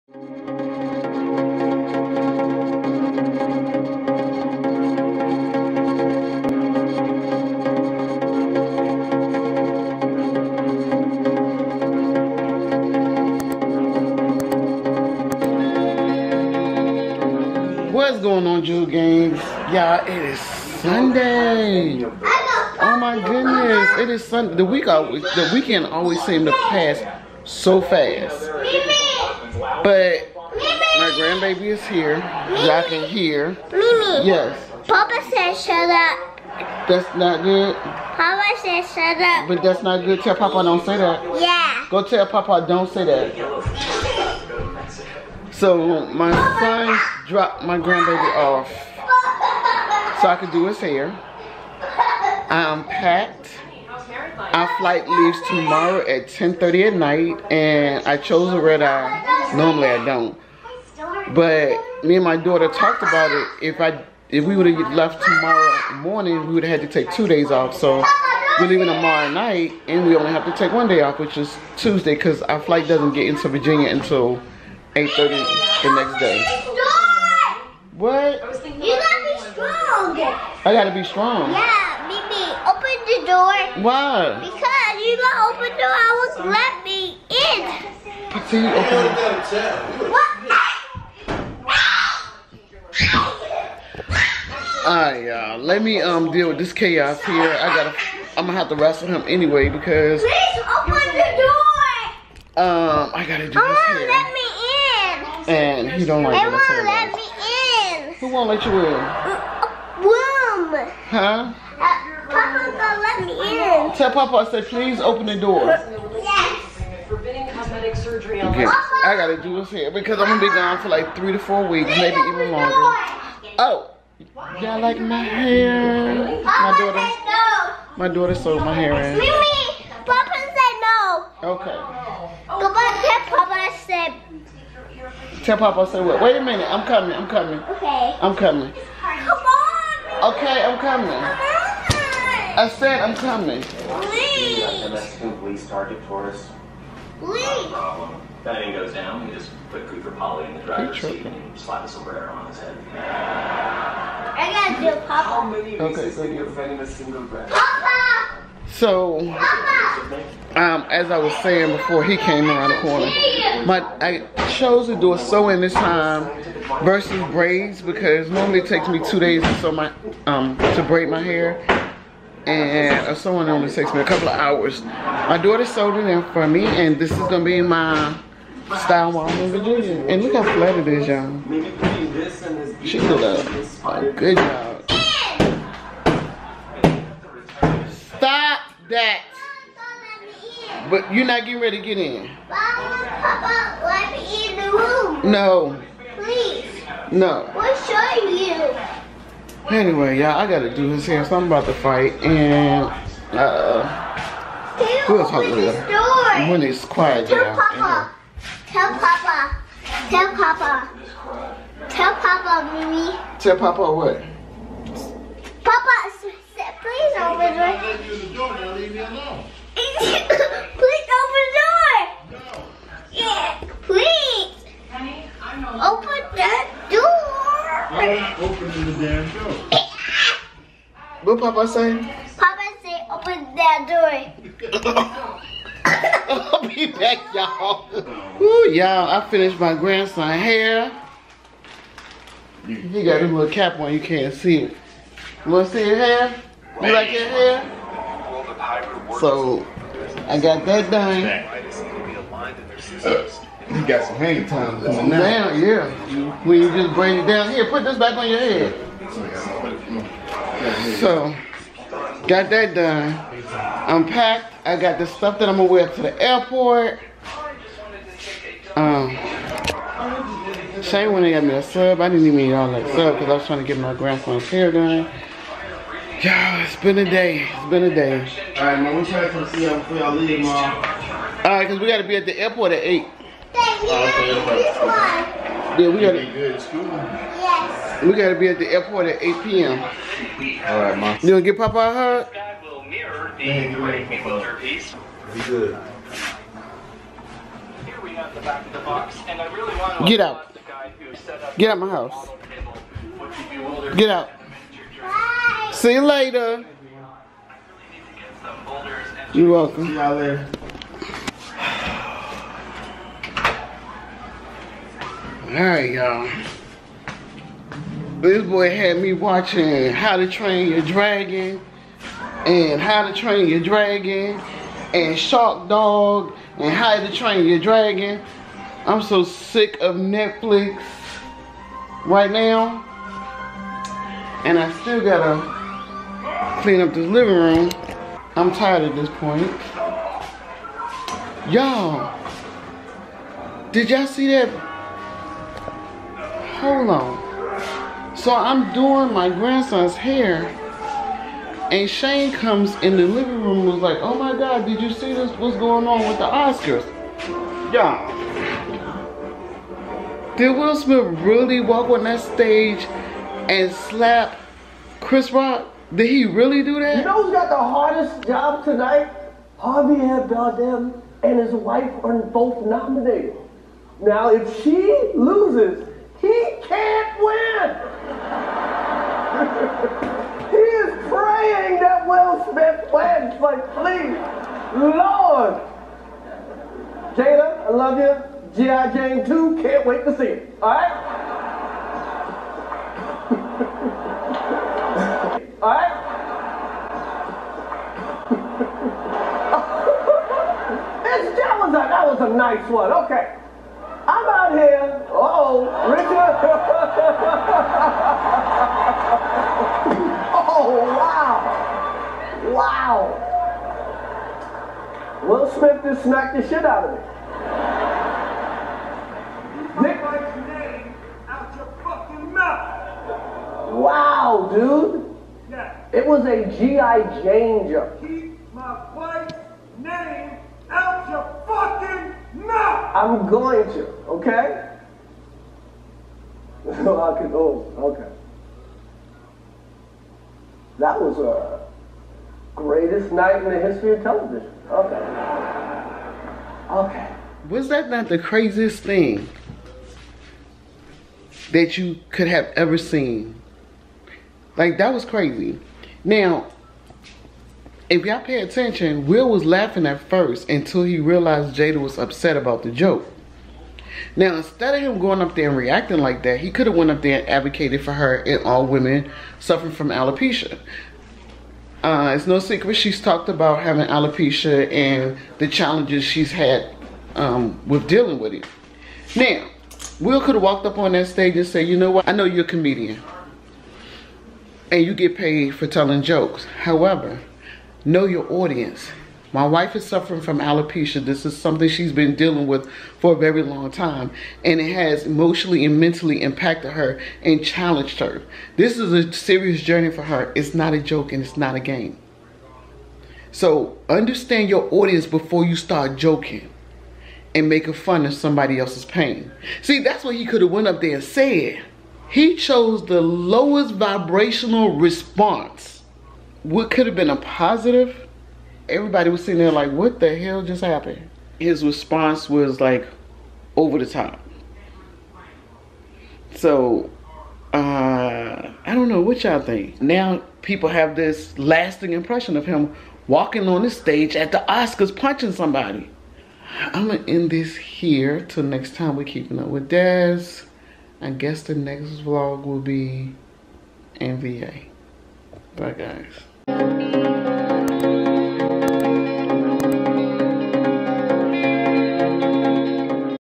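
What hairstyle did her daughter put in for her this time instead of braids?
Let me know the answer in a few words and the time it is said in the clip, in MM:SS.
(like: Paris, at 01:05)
Sew-in, at 02:45.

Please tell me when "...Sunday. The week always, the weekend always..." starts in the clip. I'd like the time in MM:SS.
00:24.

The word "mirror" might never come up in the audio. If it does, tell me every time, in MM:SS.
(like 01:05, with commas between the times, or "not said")
04:52.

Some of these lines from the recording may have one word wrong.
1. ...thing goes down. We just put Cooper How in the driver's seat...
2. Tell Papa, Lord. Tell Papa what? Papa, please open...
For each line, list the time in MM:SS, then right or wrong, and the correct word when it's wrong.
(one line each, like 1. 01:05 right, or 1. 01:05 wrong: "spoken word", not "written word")
1. 02:28 wrong: "Polly", not "How"
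2. 03:31 wrong: "Mimi", not "Lord".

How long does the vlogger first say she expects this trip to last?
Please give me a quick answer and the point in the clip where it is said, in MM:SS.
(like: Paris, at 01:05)
3 to 4 weeks, at 02:01.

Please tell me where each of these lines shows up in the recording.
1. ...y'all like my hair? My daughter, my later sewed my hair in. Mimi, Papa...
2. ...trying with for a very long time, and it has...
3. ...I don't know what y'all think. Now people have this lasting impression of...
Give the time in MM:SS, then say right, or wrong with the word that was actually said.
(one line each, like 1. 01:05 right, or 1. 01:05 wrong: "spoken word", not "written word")
1. 02:04 wrong: "daughter", not "later"
2. 08:12 wrong: "dealing", not "trying"
3. 08:48 right.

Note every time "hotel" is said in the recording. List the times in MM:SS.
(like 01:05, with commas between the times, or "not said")
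not said.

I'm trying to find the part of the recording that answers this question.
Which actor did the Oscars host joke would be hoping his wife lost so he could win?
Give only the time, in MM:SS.
06:09.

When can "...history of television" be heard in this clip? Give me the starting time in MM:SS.
07:23.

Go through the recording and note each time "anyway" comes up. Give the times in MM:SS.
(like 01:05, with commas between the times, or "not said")
01:39, 03:19.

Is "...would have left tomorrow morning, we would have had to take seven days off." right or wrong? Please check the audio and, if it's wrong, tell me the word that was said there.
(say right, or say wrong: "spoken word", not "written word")
wrong: "two", not "seven".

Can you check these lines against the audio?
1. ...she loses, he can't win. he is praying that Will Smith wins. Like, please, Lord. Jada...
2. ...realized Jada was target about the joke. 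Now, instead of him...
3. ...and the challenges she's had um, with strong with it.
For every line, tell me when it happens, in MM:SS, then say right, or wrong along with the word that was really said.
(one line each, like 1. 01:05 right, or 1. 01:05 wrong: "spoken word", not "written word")
1. 06:14 right
2. 07:40 wrong: "upset", not "target"
3. 07:54 wrong: "dealing", not "strong".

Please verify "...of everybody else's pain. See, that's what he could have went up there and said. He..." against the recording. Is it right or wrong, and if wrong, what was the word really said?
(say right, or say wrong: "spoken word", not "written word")
wrong: "somebody", not "everybody".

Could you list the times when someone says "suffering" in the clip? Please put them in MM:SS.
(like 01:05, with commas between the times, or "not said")
07:49, 08:09.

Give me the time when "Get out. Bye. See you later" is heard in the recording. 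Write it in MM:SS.
05:03.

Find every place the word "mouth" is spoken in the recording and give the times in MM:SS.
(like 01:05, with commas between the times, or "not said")
07:02, 07:12.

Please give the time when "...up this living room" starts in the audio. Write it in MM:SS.
05:36.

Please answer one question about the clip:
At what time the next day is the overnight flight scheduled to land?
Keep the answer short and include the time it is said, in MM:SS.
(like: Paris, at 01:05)
8:30, at 01:14.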